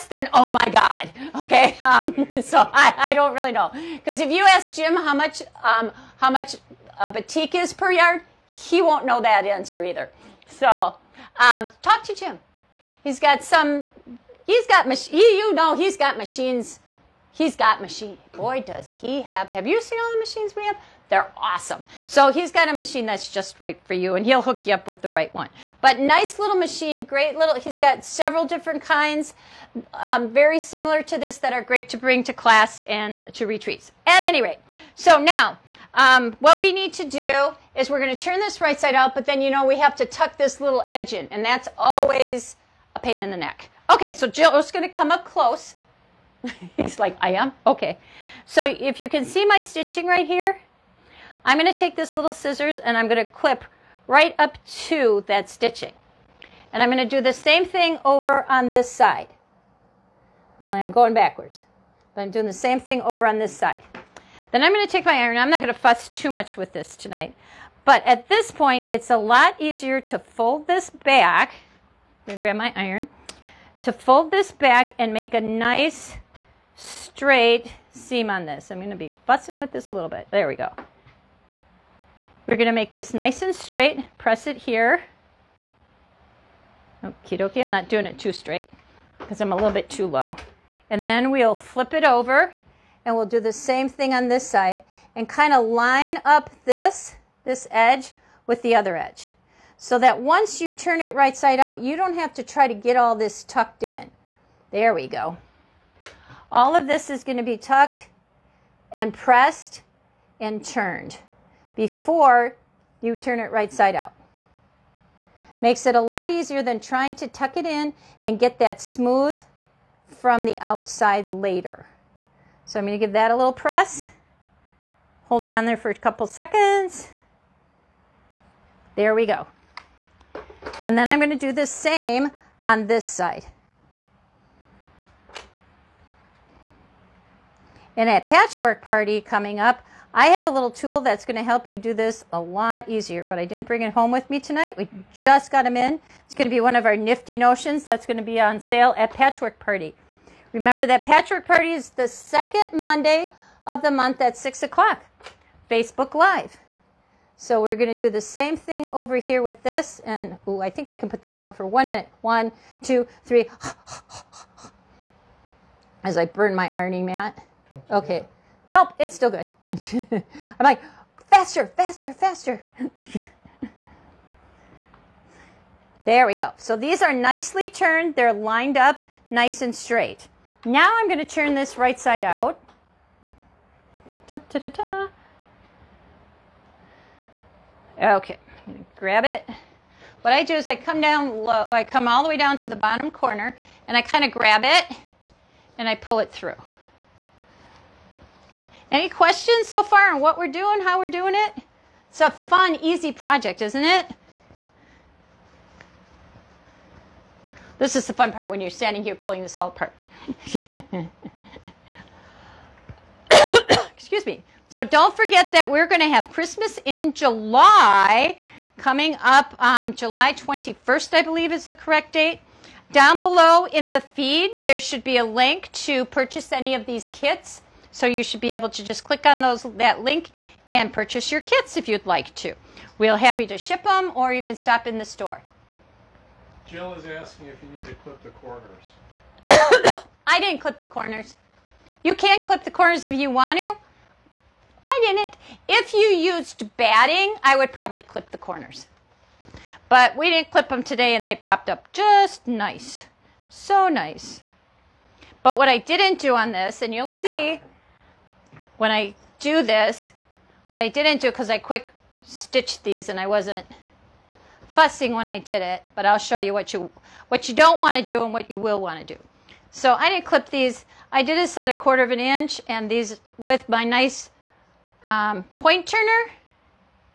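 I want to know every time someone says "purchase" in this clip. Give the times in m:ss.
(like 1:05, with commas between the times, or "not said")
3:46, 3:50.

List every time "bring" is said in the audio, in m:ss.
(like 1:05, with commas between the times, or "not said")
0:31, 2:23.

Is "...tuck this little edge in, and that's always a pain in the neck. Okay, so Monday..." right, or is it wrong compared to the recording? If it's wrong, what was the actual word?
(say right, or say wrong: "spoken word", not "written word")
wrong: "Jill", not "Monday".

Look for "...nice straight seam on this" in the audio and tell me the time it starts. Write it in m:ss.
1:15.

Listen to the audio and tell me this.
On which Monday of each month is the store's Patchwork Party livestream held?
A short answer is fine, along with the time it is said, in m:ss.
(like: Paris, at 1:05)
Second Monday, at 2:32.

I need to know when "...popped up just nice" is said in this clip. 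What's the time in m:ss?
4:11.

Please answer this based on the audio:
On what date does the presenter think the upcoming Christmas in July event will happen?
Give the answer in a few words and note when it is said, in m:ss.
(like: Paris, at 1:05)
July 21, at 3:39.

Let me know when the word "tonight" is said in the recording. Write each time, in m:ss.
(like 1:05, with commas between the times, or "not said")
1:06, 2:24.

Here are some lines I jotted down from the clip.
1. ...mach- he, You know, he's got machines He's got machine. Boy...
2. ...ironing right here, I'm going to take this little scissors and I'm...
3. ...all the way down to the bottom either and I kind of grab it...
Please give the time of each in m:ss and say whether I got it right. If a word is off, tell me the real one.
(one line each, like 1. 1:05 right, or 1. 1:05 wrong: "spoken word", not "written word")
1. 0:14 right
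2. 0:49 wrong: "stitching", not "ironing"
3. 3:12 wrong: "corner", not "either".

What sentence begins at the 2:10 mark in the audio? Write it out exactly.
And then I'm going to do the same on this side.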